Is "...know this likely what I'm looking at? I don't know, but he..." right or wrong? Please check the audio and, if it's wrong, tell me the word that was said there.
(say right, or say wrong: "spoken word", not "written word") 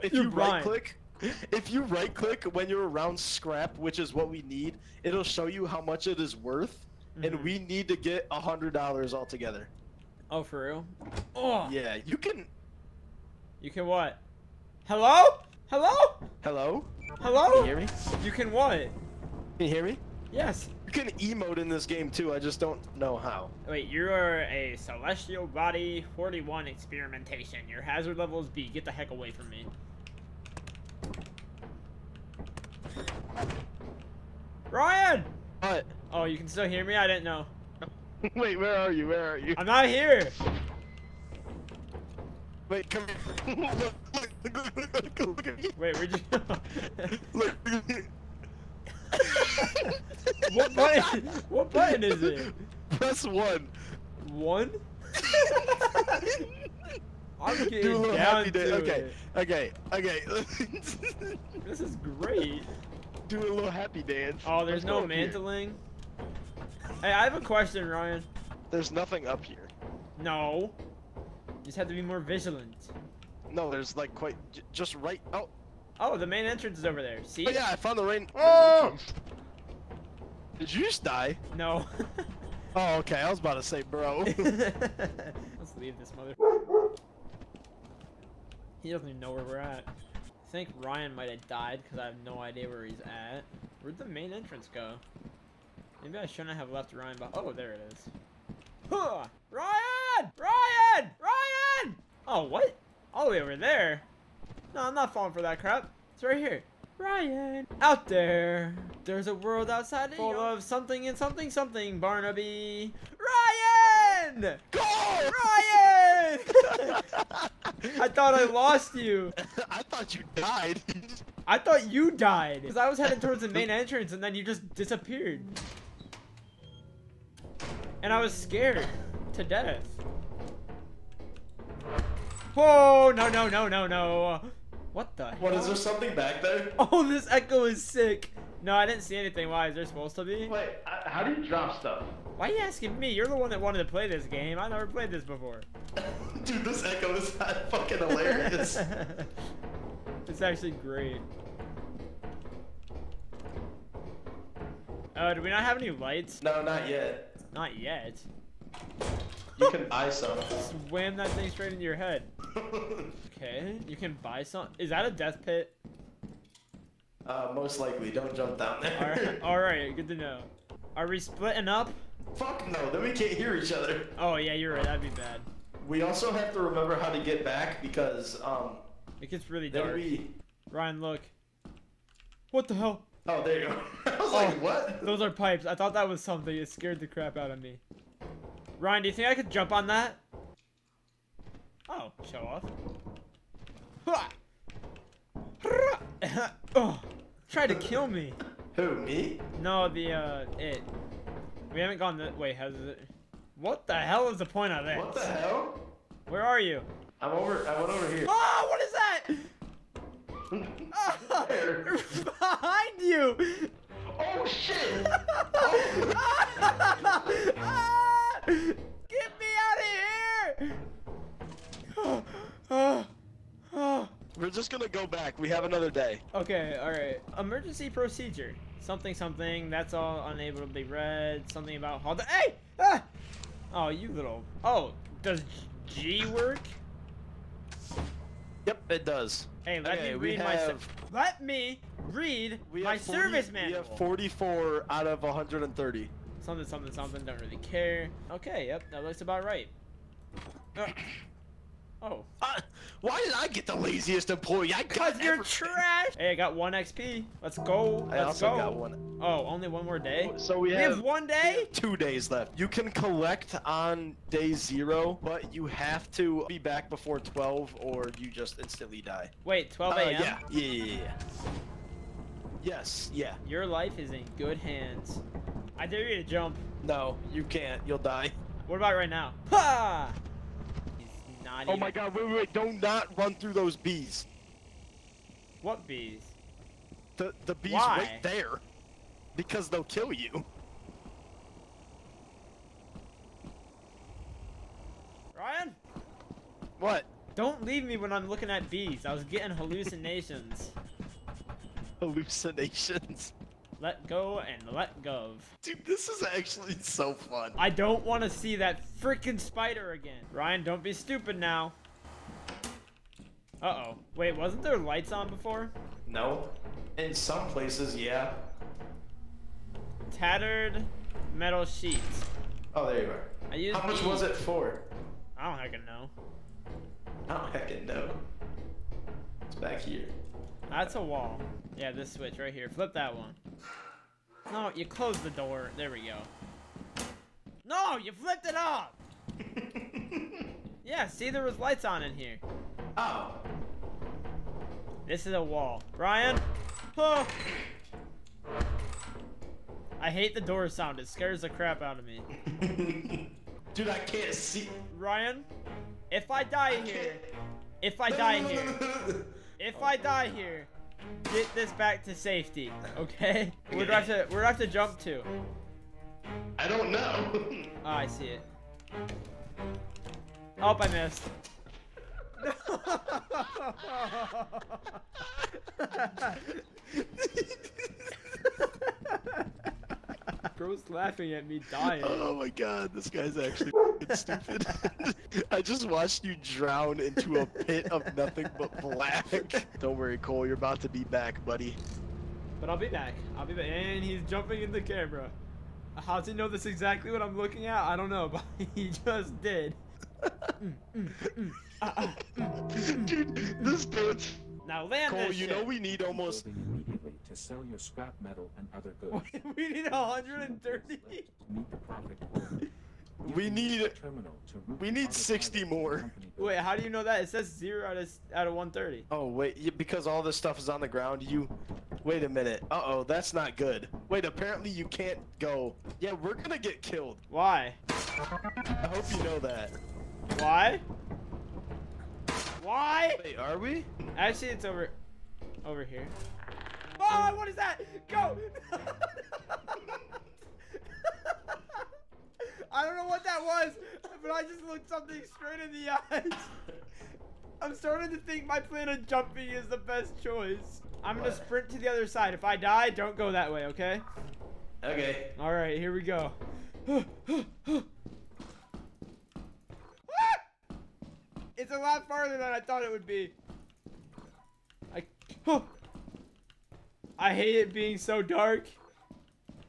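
wrong: "exactly", not "likely".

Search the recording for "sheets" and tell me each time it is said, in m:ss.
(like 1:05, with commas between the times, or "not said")
5:21.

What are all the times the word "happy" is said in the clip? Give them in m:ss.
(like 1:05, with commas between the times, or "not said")
0:58, 1:03.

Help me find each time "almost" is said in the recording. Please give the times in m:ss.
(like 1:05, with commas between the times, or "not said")
6:46.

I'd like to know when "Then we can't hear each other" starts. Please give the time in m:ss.
2:52.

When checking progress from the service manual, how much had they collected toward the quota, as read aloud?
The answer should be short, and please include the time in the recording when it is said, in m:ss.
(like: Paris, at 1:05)
44, at 4:03.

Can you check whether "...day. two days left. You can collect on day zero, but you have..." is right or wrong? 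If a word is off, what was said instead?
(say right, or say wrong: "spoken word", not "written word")
right.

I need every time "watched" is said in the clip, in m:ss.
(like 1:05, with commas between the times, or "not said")
6:25.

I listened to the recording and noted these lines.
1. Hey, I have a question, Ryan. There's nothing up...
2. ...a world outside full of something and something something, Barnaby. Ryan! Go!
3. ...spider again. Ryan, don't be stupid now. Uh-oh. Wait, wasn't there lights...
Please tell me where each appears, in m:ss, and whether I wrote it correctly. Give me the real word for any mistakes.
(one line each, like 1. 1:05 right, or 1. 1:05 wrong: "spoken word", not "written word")
1. 1:07 right
2. 1:49 right
3. 5:09 right.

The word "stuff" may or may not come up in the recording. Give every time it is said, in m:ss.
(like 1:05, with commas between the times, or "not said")
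2:21, 7:00.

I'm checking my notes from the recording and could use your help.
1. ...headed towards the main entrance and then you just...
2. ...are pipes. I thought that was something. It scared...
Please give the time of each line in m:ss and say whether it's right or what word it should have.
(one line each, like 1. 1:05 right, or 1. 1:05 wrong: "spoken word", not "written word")
1. 2:02 right
2. 3:05 right.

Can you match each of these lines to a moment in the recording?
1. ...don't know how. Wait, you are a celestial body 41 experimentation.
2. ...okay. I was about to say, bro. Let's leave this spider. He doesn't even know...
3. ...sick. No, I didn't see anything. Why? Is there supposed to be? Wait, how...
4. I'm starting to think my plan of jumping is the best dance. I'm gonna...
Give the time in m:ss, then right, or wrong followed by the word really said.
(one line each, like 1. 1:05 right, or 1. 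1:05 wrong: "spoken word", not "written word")
1. 0:22 right
2. 1:22 wrong: "mother", not "spider"
3. 2:17 right
4. 7:27 wrong: "choice", not "dance".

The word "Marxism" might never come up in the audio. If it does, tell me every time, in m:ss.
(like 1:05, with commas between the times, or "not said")
not said.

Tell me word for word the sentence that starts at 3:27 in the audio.
I'm over, I went over here.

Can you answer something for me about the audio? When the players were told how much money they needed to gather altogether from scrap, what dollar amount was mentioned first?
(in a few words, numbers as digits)
$100.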